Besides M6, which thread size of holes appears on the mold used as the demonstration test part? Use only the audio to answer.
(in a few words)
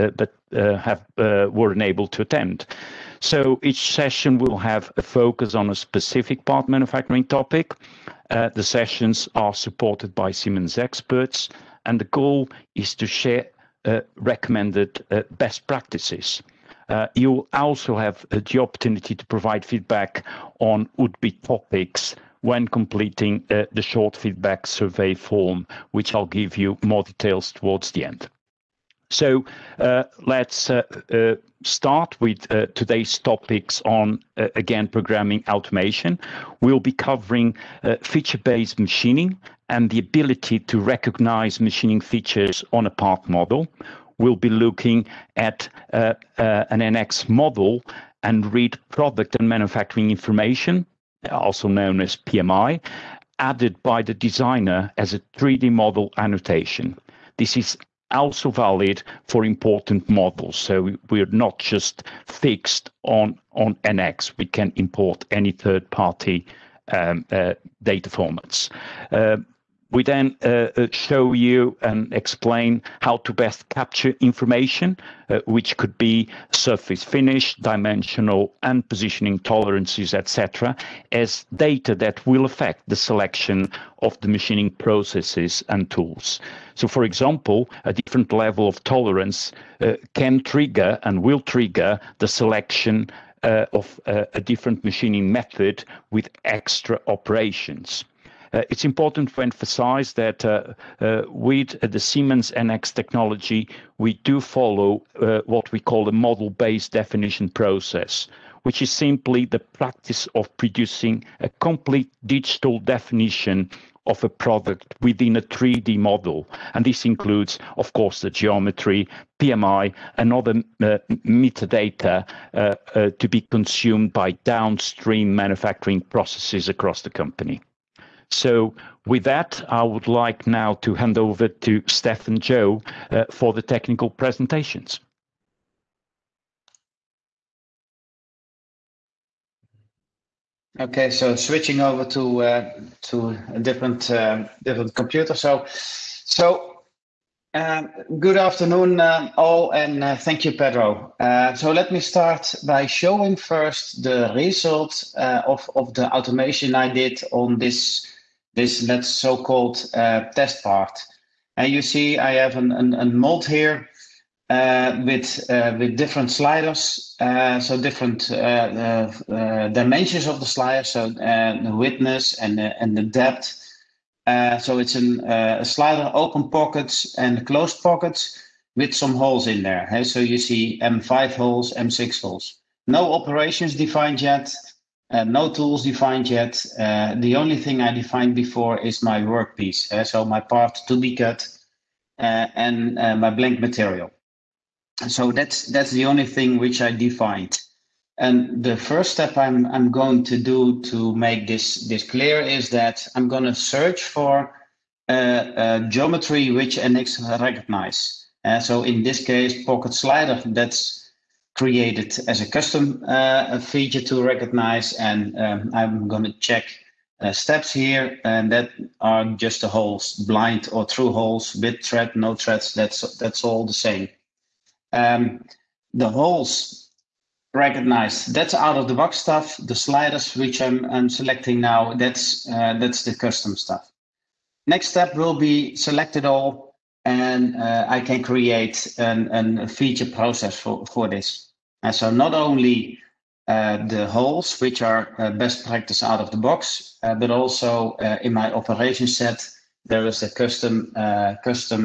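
M5.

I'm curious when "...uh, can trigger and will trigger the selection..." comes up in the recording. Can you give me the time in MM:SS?
01:29.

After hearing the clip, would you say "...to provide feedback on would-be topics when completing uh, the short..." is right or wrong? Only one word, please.
right.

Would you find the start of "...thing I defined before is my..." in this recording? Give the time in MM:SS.
03:07.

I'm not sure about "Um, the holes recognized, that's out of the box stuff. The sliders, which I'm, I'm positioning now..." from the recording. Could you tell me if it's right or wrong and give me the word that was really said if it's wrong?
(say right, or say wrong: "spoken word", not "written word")
wrong: "selecting", not "positioning".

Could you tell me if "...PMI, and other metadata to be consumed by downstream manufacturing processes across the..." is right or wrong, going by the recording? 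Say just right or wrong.
right.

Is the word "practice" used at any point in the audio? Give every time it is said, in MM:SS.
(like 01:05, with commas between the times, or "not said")
00:15, 01:49, 04:05.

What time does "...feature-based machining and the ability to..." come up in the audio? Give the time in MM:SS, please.
00:38.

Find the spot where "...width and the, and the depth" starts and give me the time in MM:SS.
02:51.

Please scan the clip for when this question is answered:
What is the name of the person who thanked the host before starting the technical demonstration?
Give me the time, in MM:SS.
02:30.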